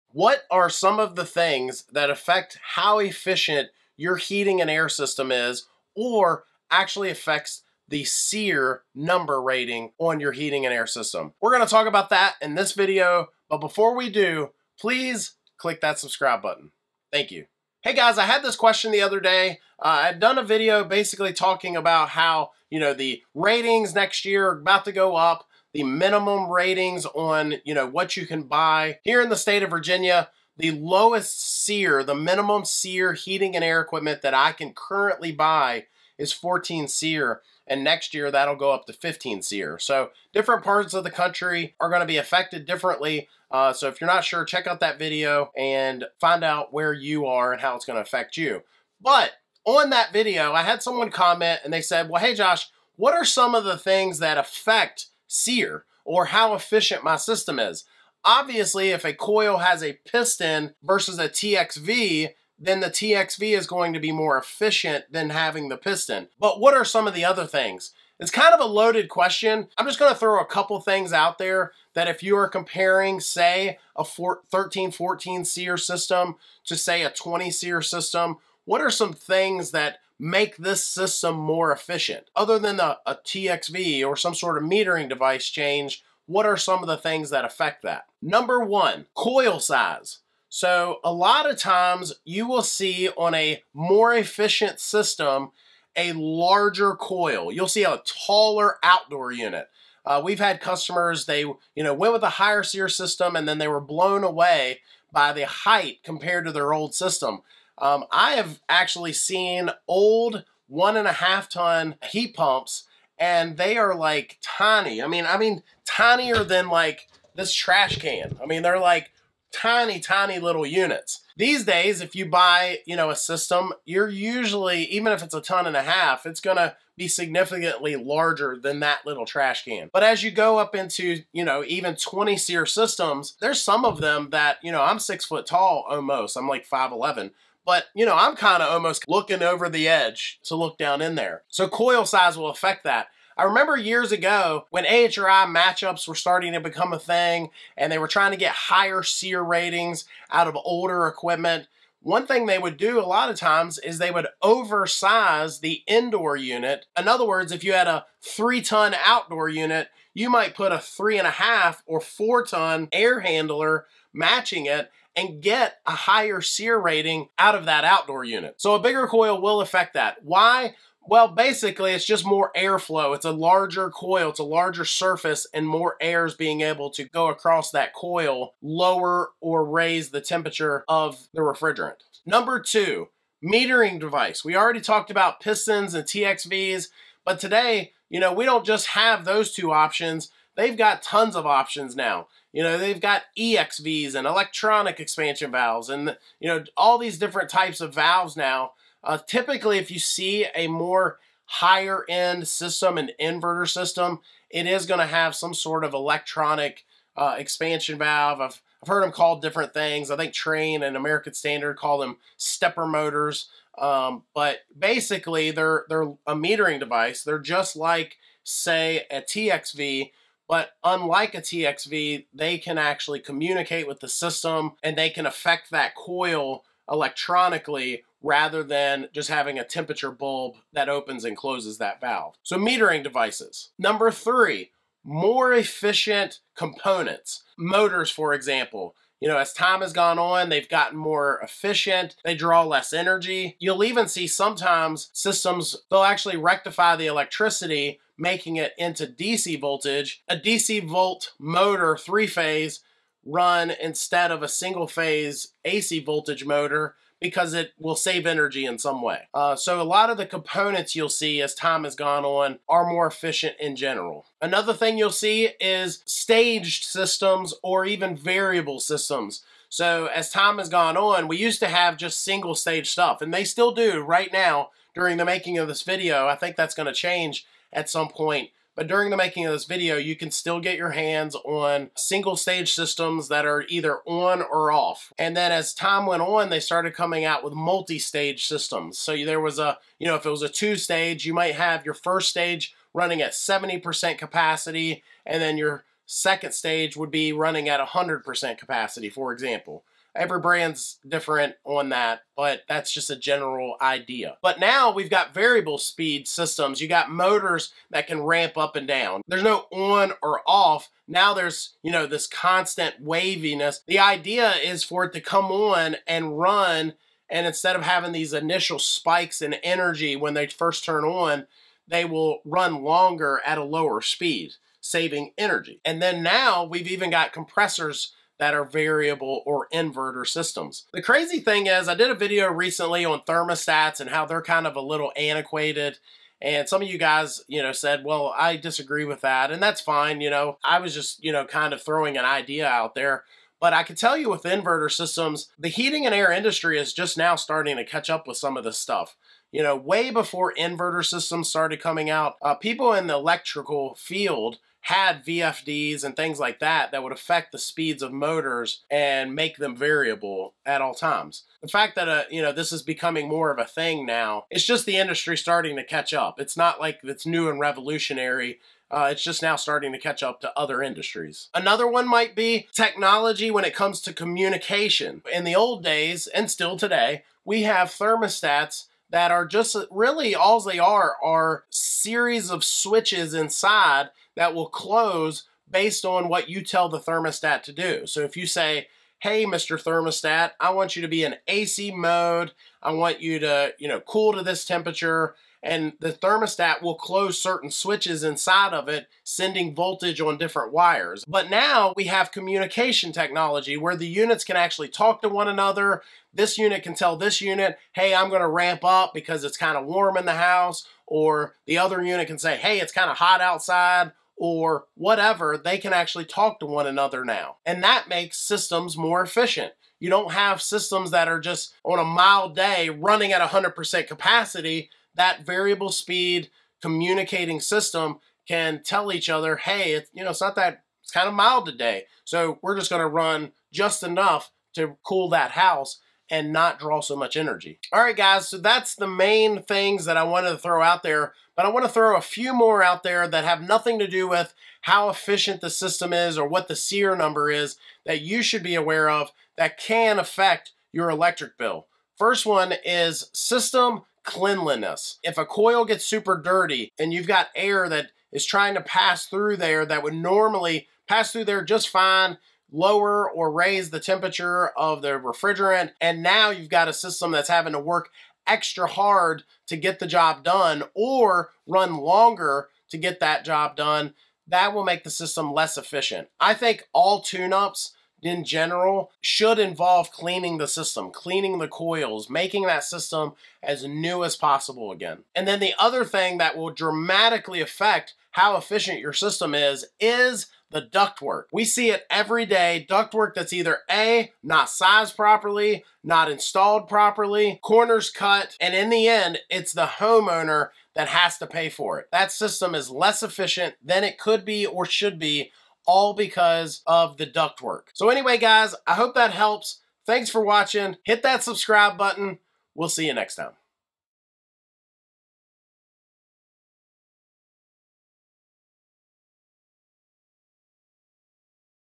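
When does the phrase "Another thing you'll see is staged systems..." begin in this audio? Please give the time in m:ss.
4:24.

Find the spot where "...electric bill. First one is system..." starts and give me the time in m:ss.
7:31.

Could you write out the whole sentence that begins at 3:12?
You know, they've got EXVs and electronic expansion valves and, you know, all these different types of valves now.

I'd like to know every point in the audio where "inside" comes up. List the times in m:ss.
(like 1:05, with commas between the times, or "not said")
6:23, 6:38.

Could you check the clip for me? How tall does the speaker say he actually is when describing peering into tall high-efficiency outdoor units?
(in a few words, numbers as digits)
5'11".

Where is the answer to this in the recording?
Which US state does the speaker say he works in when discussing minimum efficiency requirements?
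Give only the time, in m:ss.
0:29.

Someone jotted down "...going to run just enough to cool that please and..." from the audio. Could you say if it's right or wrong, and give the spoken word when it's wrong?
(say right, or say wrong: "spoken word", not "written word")
wrong: "house", not "please".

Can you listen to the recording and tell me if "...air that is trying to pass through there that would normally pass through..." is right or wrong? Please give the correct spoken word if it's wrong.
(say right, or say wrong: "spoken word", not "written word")
right.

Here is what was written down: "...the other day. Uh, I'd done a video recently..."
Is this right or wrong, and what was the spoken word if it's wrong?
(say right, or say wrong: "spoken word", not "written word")
wrong: "basically", not "recently".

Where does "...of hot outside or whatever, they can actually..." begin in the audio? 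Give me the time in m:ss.
6:53.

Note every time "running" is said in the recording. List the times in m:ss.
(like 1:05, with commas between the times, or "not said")
4:52, 4:57, 7:02.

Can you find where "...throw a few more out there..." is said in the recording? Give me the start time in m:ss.
7:21.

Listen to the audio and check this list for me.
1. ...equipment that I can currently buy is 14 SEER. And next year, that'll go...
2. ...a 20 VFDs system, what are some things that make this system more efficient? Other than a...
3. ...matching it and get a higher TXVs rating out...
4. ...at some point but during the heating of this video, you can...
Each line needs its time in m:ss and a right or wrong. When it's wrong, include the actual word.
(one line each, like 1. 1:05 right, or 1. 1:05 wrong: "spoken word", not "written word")
1. 0:33 right
2. 1:17 wrong: "SEER", not "VFDs"
3. 2:44 wrong: "SEER", not "TXVs"
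4. 4:37 wrong: "making", not "heating".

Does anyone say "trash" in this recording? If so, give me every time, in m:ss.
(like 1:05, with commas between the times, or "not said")
1:57, 2:09.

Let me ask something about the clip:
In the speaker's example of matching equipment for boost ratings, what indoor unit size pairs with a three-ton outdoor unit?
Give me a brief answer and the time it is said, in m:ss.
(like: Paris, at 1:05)
3.5 or 4 ton, at 2:40.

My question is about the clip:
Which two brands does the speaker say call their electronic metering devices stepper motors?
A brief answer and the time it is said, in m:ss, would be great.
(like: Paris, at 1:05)
Trane and American Standard, at 3:30.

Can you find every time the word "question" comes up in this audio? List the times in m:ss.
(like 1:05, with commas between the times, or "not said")
0:18, 1:09.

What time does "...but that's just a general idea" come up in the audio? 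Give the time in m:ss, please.
5:02.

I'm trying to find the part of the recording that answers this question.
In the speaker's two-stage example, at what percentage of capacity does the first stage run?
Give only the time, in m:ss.
4:53.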